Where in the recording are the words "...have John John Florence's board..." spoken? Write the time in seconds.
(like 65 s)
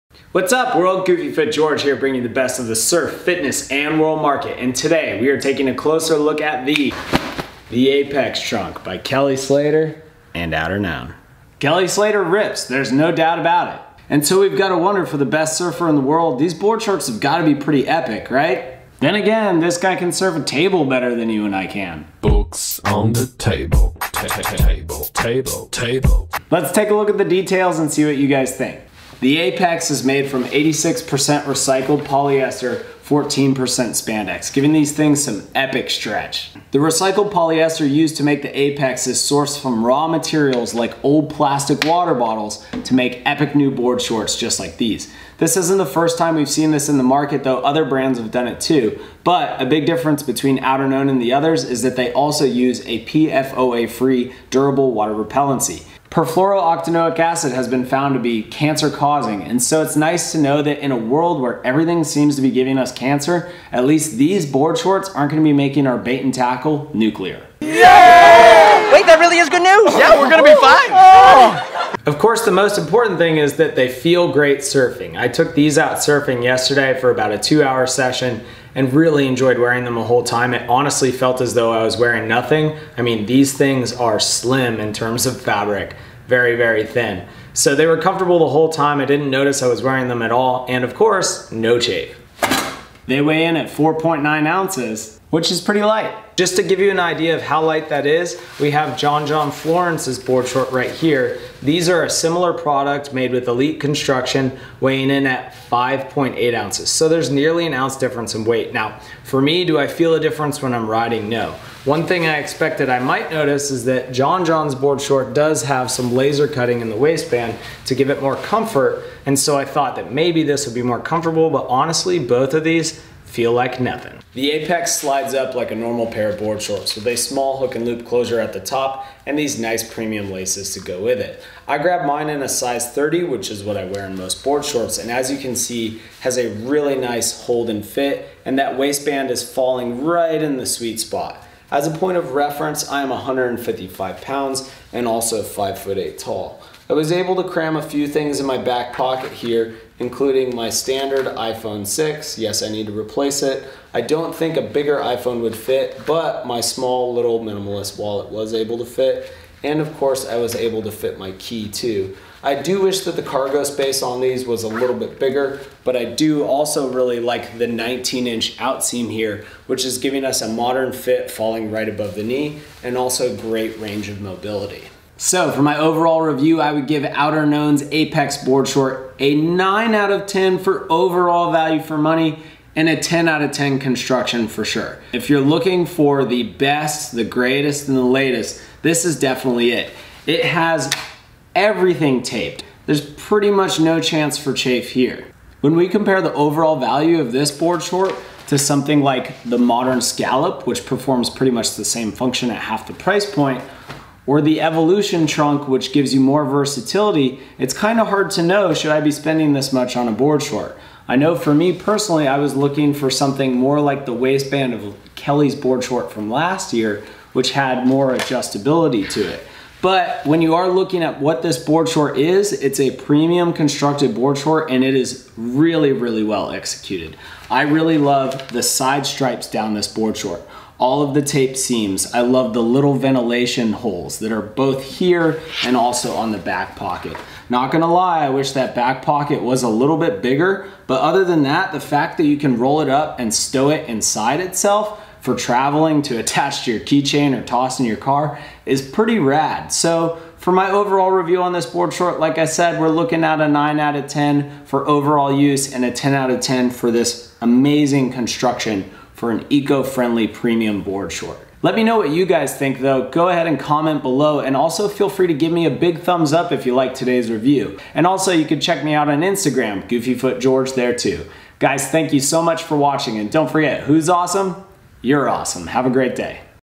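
98 s.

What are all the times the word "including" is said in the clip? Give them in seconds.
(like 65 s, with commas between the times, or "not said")
149 s.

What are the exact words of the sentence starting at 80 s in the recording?
It honestly felt as though I was wearing nothing.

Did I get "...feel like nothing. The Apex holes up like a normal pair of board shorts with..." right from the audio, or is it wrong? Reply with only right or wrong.
wrong.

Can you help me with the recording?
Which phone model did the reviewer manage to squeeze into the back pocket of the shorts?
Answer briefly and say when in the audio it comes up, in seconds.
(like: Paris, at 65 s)
iPhone 6, at 151 s.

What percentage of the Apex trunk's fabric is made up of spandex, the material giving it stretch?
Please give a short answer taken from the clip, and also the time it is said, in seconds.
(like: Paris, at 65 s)
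14%, at 33 s.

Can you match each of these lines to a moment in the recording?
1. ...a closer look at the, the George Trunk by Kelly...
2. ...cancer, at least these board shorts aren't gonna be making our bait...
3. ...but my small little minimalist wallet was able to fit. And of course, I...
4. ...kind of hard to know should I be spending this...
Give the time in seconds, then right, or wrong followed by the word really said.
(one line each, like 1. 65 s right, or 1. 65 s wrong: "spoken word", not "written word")
1. 5 s wrong: "Apex", not "George"
2. 62 s right
3. 156 s right
4. 207 s right.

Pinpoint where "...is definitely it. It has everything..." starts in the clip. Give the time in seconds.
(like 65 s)
189 s.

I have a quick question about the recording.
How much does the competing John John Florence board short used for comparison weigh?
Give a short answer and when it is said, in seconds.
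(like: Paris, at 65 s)
5.8 ounces, at 105 s.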